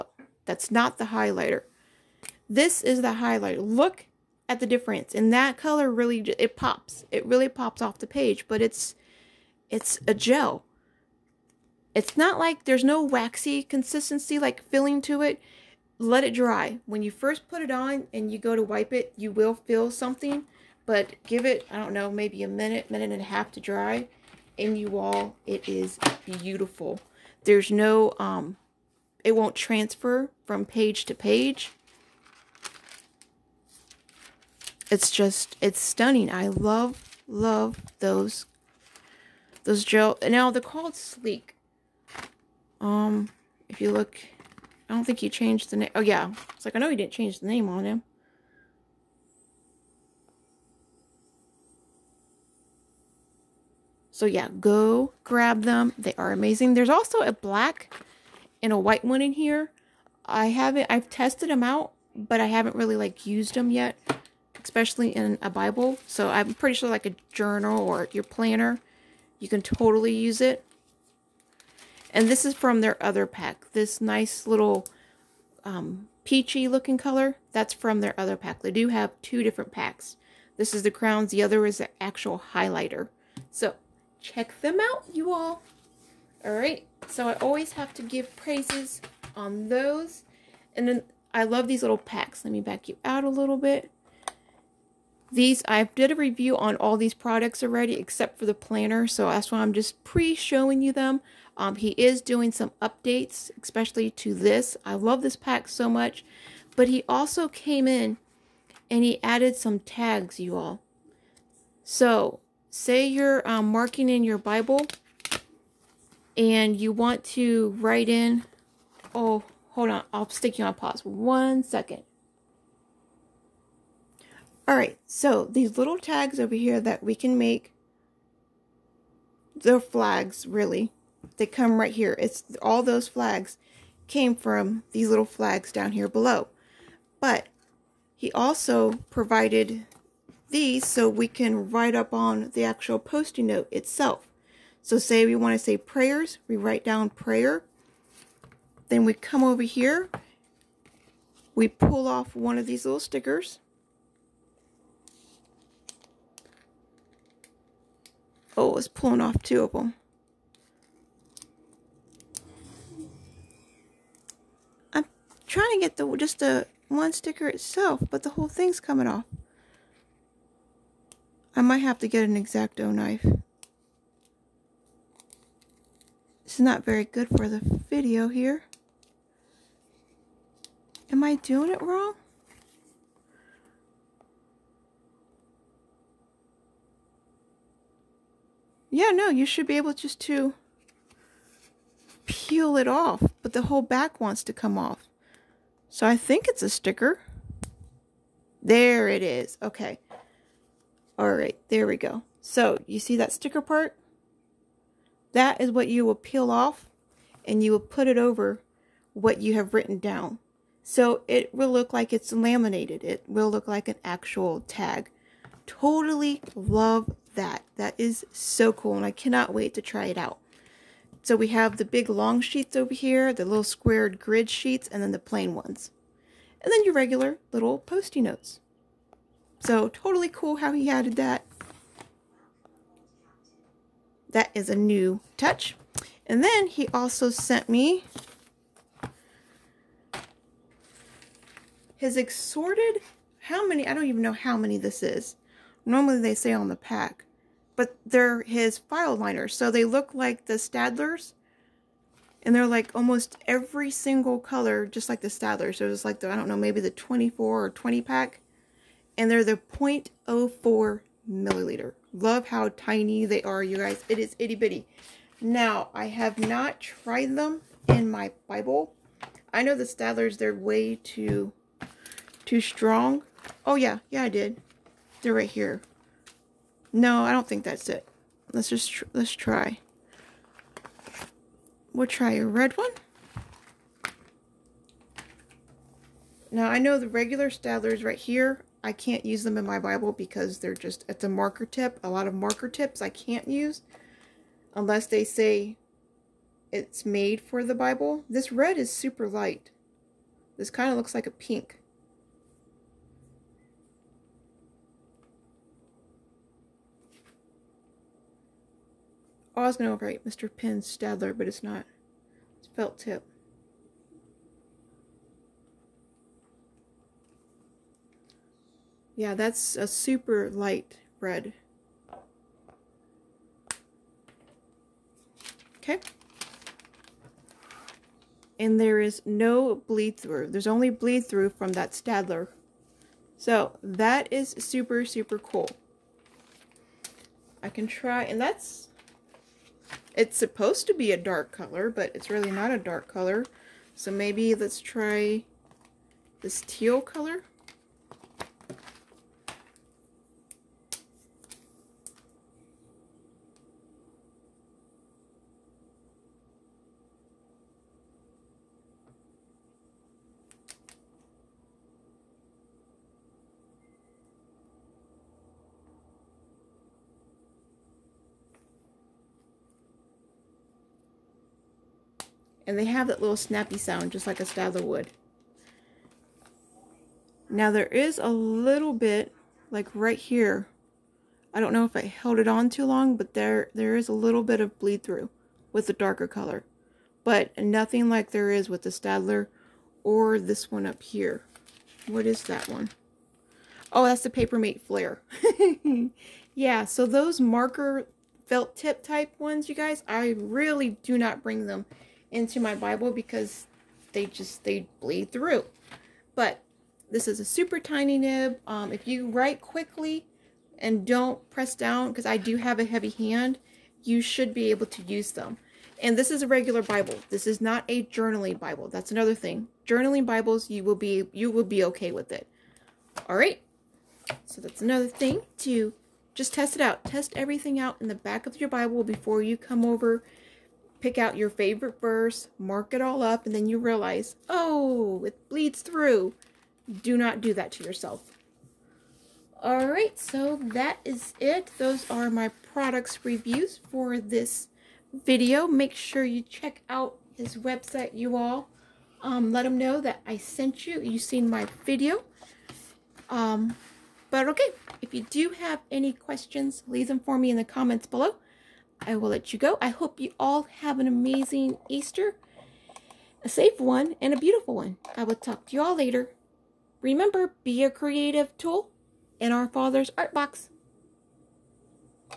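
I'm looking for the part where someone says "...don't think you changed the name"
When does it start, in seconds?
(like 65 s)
44 s.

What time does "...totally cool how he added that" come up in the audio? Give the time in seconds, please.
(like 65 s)
229 s.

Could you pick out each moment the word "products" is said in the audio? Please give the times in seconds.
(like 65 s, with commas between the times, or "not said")
97 s, 442 s.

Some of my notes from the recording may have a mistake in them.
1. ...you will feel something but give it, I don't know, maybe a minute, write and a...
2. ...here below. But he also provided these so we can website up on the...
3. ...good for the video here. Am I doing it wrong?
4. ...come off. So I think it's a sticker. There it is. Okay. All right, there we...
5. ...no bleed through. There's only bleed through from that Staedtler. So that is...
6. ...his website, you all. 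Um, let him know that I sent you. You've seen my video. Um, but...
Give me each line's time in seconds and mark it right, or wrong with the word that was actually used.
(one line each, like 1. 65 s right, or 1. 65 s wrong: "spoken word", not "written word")
1. 19 s wrong: "minute", not "write"
2. 135 s wrong: "write", not "website"
3. 177 s right
4. 194 s right
5. 329 s right
6. 447 s right.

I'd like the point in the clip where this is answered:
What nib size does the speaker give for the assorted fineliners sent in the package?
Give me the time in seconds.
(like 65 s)
259 s.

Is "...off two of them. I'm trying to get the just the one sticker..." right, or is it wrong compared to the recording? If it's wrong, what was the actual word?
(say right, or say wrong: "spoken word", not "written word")
right.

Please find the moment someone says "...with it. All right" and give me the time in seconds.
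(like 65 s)
422 s.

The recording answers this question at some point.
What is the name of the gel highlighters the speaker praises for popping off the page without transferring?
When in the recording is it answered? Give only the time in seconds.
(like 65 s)
40 s.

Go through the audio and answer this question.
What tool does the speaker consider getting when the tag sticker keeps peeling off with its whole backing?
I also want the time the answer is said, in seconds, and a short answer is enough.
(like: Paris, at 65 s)
An X-Acto knife, at 172 s.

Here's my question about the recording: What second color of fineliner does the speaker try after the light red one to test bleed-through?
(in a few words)
Teal.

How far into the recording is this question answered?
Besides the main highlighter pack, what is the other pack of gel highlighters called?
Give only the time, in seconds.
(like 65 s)
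80 s.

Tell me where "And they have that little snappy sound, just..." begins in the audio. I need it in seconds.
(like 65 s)
372 s.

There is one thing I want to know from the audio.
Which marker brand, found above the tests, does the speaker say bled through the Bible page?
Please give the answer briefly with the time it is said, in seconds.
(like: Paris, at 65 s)
Papermate Flair, at 394 s.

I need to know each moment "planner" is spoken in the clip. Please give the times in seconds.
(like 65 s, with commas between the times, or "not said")
68 s, 98 s.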